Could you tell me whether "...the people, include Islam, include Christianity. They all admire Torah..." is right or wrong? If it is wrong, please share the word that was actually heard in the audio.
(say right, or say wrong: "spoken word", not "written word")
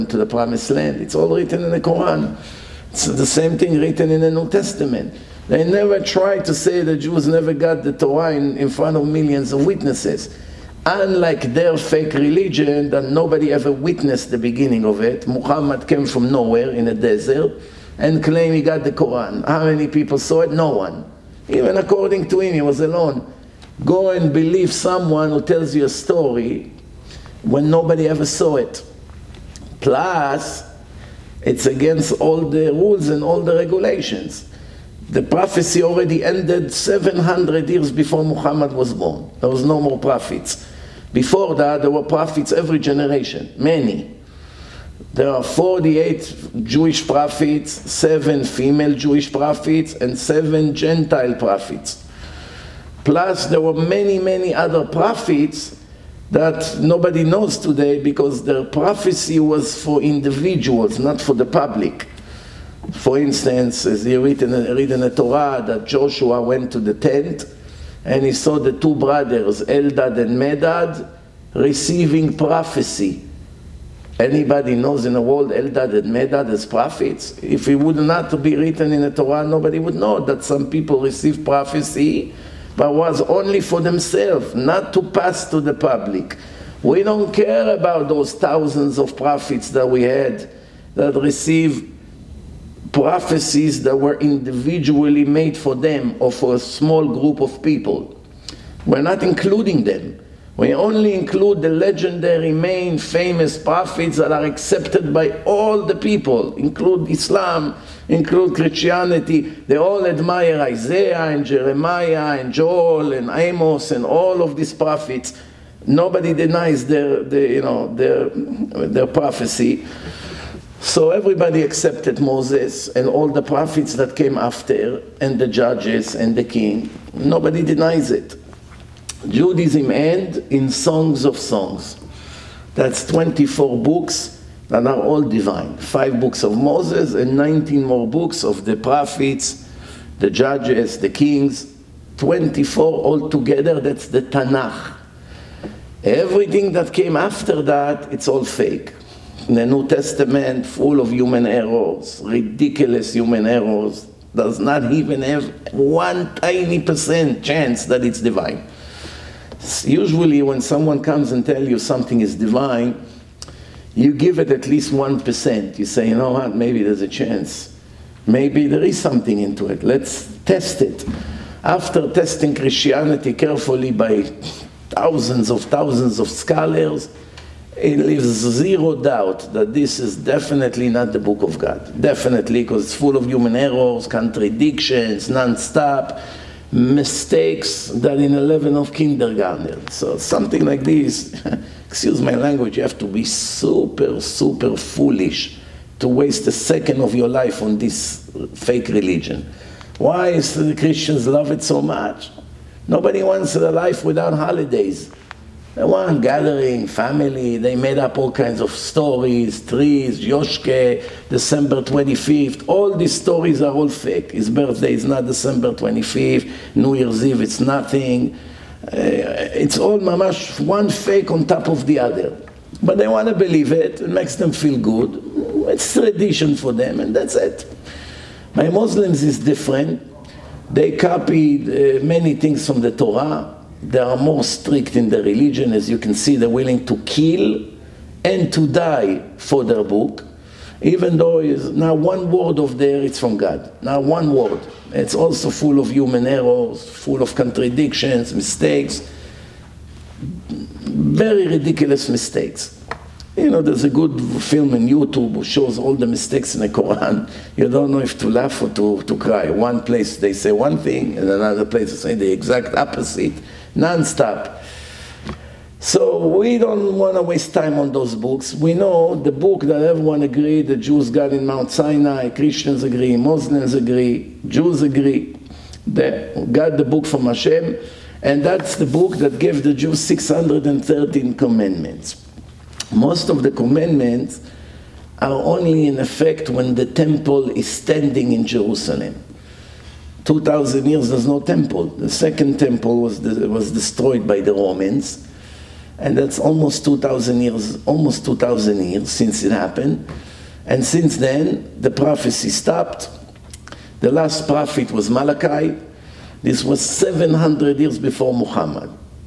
wrong: "Isaiah", not "Torah".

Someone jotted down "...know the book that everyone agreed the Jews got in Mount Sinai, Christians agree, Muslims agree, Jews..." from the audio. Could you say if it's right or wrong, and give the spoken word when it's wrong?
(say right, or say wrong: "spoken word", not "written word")
right.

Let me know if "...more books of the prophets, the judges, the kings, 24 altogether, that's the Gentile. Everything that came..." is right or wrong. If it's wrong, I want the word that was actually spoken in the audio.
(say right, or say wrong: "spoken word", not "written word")
wrong: "Tanakh", not "Gentile".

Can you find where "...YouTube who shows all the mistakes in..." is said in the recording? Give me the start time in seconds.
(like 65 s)
254 s.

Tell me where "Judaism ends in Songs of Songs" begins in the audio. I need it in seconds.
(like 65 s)
129 s.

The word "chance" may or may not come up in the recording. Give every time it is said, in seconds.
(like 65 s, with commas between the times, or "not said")
157 s, 167 s.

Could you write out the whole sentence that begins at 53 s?
Plus, there were many, many other prophets that nobody knows today because their prophecy was for individuals, not for the public.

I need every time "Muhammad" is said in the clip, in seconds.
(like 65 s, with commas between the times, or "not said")
15 s, 38 s, 308 s.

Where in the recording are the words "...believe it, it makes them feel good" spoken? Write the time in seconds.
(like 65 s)
223 s.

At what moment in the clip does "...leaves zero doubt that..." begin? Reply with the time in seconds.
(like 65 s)
177 s.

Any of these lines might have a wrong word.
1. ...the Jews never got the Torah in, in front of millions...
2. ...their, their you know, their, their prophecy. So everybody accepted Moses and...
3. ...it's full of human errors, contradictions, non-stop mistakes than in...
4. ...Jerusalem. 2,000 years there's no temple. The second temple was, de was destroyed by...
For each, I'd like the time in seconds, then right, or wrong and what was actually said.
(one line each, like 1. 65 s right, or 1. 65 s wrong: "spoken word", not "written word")
1. 6 s right
2. 116 s right
3. 182 s right
4. 288 s right.